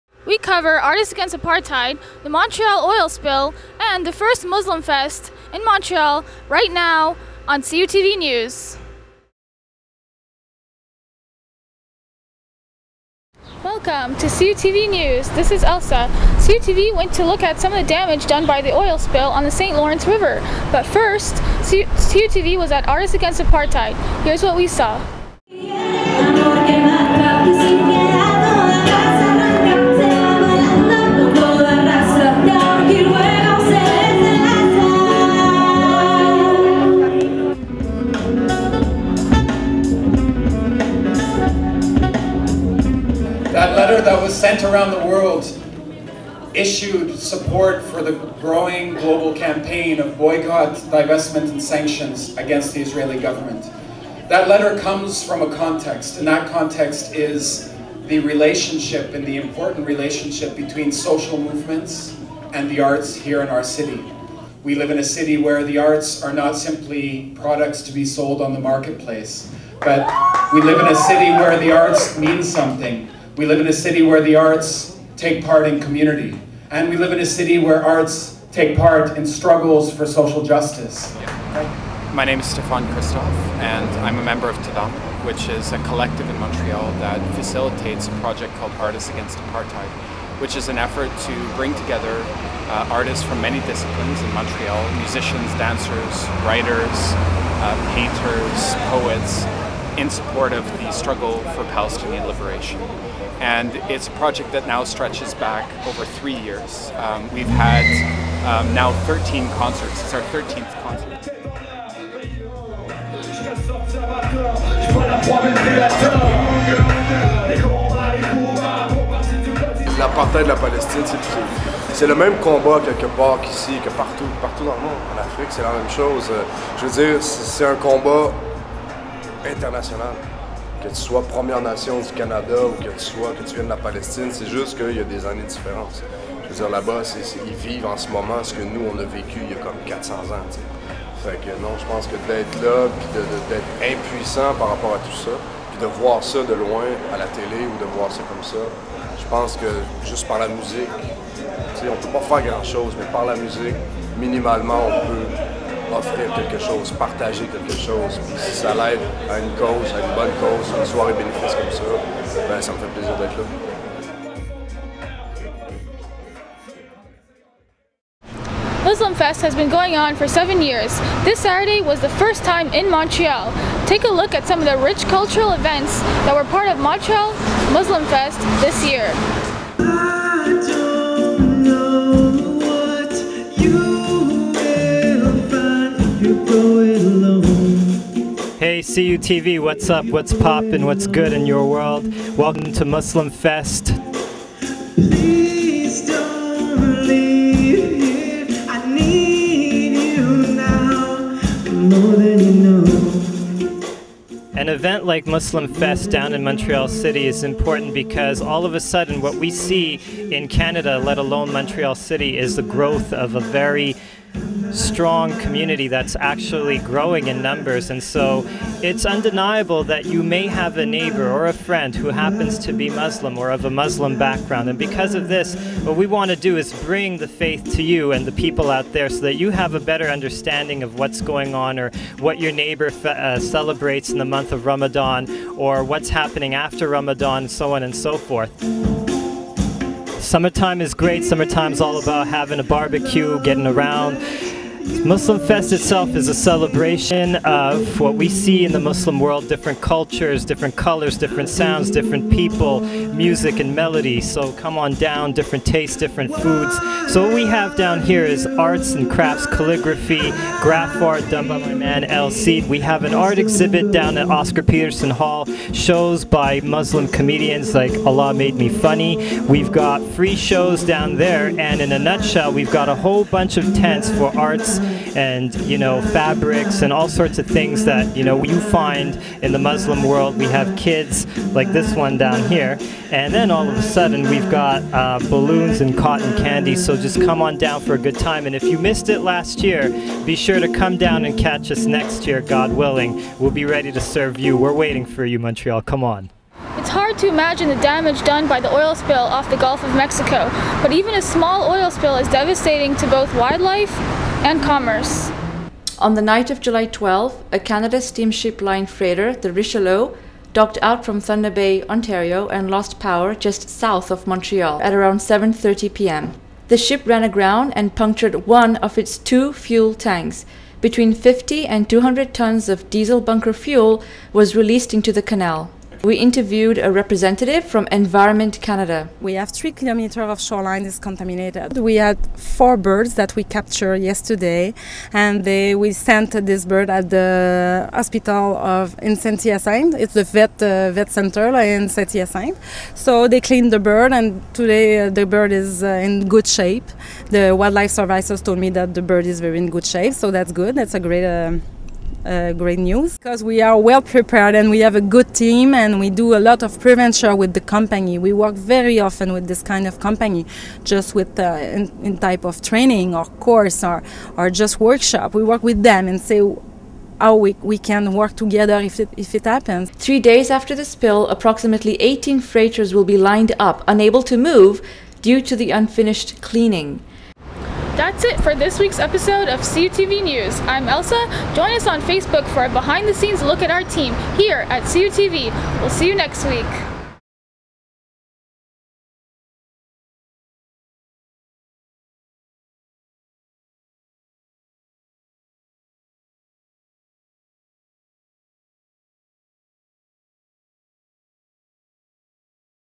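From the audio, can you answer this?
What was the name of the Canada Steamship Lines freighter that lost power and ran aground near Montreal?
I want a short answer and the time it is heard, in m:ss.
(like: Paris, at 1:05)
Richelieu, at 5:09.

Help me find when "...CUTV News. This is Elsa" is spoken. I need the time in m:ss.
0:14.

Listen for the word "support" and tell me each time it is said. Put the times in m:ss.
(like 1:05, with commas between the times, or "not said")
0:47, 1:40.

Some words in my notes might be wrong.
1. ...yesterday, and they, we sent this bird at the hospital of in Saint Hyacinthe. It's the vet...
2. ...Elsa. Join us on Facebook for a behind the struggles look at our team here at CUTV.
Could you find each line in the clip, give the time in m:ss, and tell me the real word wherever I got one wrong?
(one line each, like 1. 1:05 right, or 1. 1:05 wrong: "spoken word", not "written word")
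1. 5:34 right
2. 6:20 wrong: "scenes", not "struggles".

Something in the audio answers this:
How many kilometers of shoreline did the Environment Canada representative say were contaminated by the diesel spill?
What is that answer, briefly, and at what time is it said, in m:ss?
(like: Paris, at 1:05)
3, at 5:29.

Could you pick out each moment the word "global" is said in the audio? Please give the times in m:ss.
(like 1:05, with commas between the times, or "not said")
0:48.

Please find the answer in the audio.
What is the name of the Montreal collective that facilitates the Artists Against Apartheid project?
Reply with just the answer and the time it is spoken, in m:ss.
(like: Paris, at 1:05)
TADAM, at 1:24.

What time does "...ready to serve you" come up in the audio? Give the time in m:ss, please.
4:53.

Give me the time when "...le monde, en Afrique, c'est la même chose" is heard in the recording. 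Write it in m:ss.
2:04.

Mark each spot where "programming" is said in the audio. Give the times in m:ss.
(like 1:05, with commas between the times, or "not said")
not said.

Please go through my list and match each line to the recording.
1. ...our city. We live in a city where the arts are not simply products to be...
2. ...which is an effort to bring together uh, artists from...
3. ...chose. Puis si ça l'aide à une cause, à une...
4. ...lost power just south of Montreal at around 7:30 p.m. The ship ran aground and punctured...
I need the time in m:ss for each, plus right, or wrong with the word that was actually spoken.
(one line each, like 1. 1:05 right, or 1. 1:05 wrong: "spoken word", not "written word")
1. 1:03 right
2. 1:30 right
3. 2:37 right
4. 5:12 right.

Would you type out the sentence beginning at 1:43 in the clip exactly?
And it's a project that now stretches back over three years.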